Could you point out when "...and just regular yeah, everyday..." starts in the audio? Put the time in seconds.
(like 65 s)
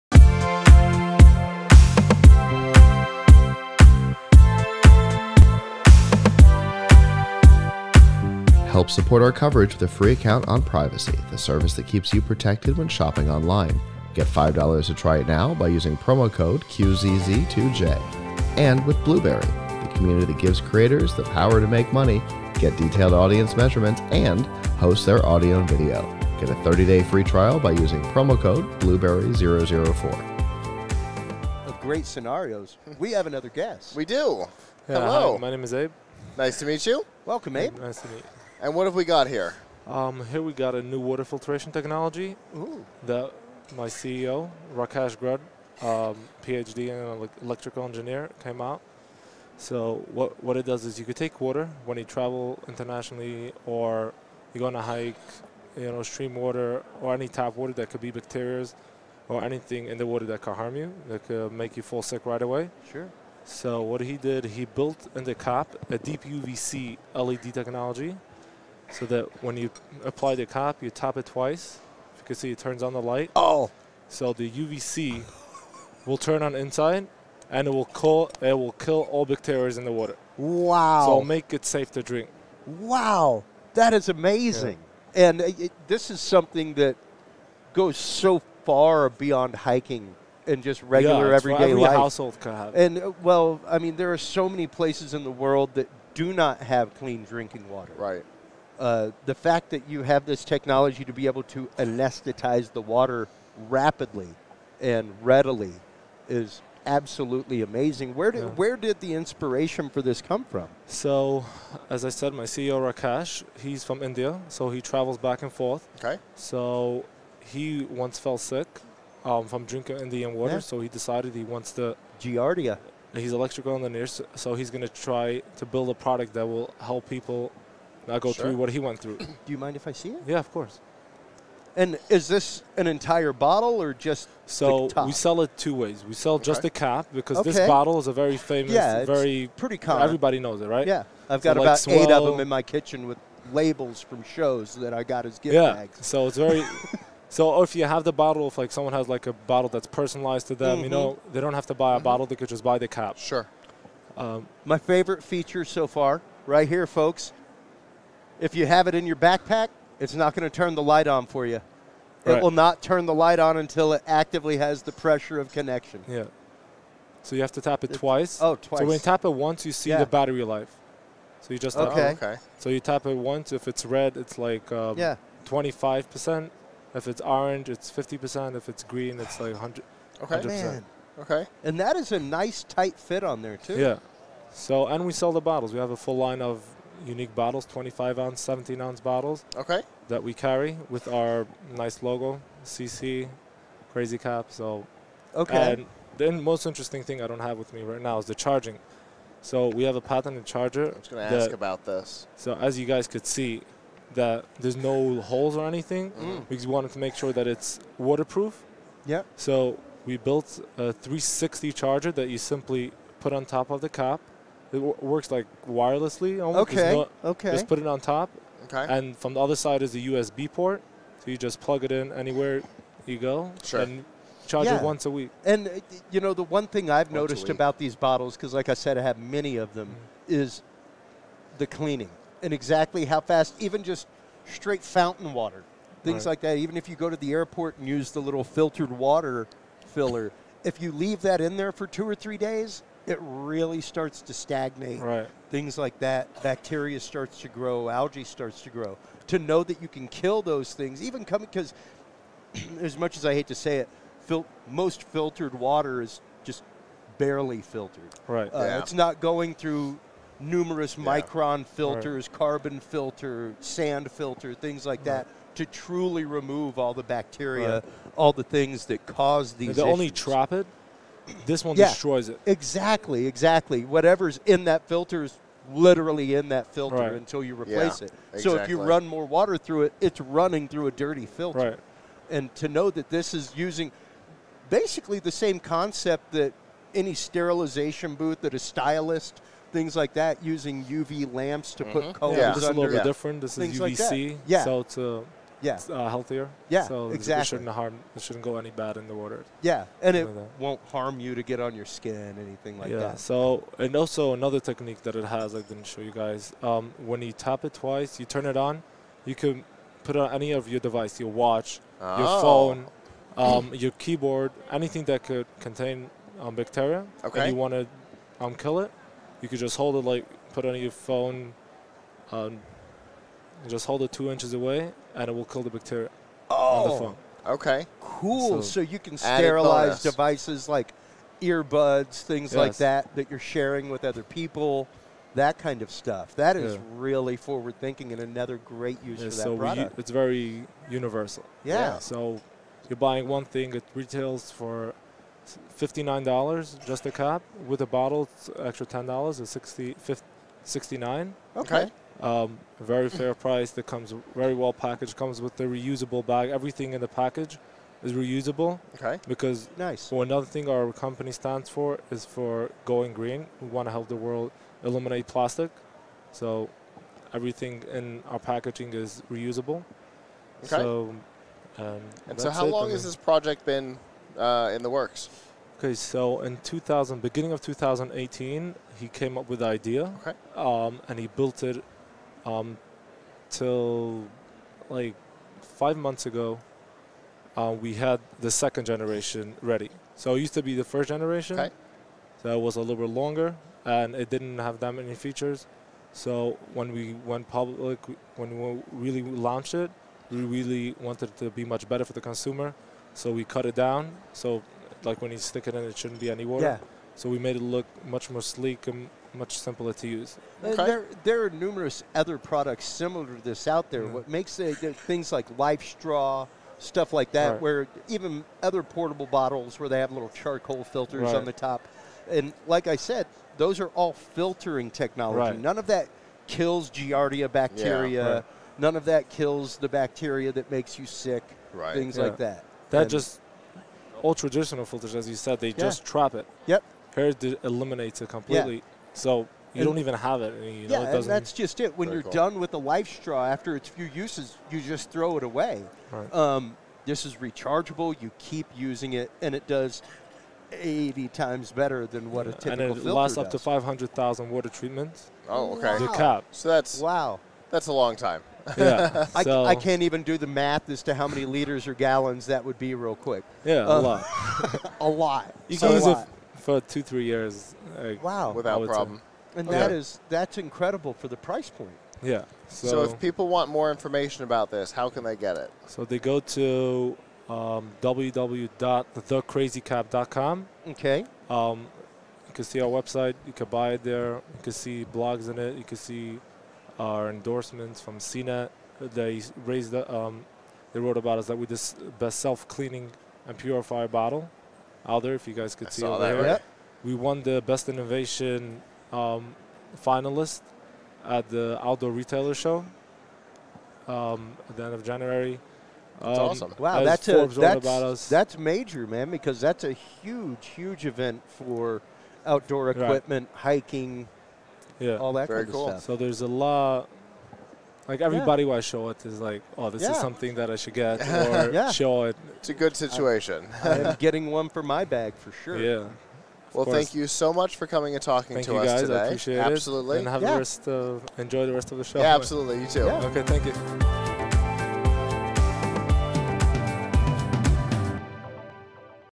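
90 s.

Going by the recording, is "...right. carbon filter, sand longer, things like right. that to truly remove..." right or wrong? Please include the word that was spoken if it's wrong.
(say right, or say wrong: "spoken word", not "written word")
wrong: "filter", not "longer".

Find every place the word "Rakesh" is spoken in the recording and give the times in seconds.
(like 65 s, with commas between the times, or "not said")
44 s, 112 s.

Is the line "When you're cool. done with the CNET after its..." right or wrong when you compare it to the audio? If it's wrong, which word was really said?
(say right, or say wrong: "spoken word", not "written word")
wrong: "LifeStraw", not "CNET".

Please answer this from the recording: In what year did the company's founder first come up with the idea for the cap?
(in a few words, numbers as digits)
2018.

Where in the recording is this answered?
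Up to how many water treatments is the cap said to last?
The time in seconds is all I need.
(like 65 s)
453 s.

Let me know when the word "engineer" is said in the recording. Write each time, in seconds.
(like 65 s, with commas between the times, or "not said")
47 s, 123 s.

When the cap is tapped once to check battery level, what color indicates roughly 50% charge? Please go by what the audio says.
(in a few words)
Orange.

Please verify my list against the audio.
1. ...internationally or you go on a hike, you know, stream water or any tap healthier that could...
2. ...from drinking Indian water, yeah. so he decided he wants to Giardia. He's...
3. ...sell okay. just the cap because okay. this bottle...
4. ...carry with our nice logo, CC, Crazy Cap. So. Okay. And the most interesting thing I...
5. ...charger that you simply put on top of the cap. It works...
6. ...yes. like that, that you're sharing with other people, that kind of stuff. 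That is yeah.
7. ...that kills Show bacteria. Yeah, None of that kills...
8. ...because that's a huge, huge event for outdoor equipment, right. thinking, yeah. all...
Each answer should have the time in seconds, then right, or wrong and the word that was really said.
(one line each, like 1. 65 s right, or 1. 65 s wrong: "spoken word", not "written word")
1. 52 s wrong: "water", not "healthier"
2. 119 s right
3. 136 s right
4. 190 s right
5. 211 s right
6. 332 s right
7. 425 s wrong: "Giardia", not "Show"
8. 509 s wrong: "hiking", not "thinking".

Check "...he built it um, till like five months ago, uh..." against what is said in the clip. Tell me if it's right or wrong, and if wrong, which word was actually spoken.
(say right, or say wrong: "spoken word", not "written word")
right.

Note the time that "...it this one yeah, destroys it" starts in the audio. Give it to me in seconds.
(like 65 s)
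270 s.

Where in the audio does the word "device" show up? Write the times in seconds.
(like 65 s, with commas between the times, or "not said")
310 s, 330 s.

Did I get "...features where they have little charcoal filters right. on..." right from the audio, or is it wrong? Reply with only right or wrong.
wrong.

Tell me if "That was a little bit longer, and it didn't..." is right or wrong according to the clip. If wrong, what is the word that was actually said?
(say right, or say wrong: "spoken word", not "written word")
right.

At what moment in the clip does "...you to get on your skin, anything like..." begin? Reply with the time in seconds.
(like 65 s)
301 s.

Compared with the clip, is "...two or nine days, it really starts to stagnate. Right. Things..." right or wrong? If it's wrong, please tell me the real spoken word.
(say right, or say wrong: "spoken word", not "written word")
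wrong: "three", not "nine".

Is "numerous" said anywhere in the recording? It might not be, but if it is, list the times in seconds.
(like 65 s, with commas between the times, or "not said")
260 s, 411 s.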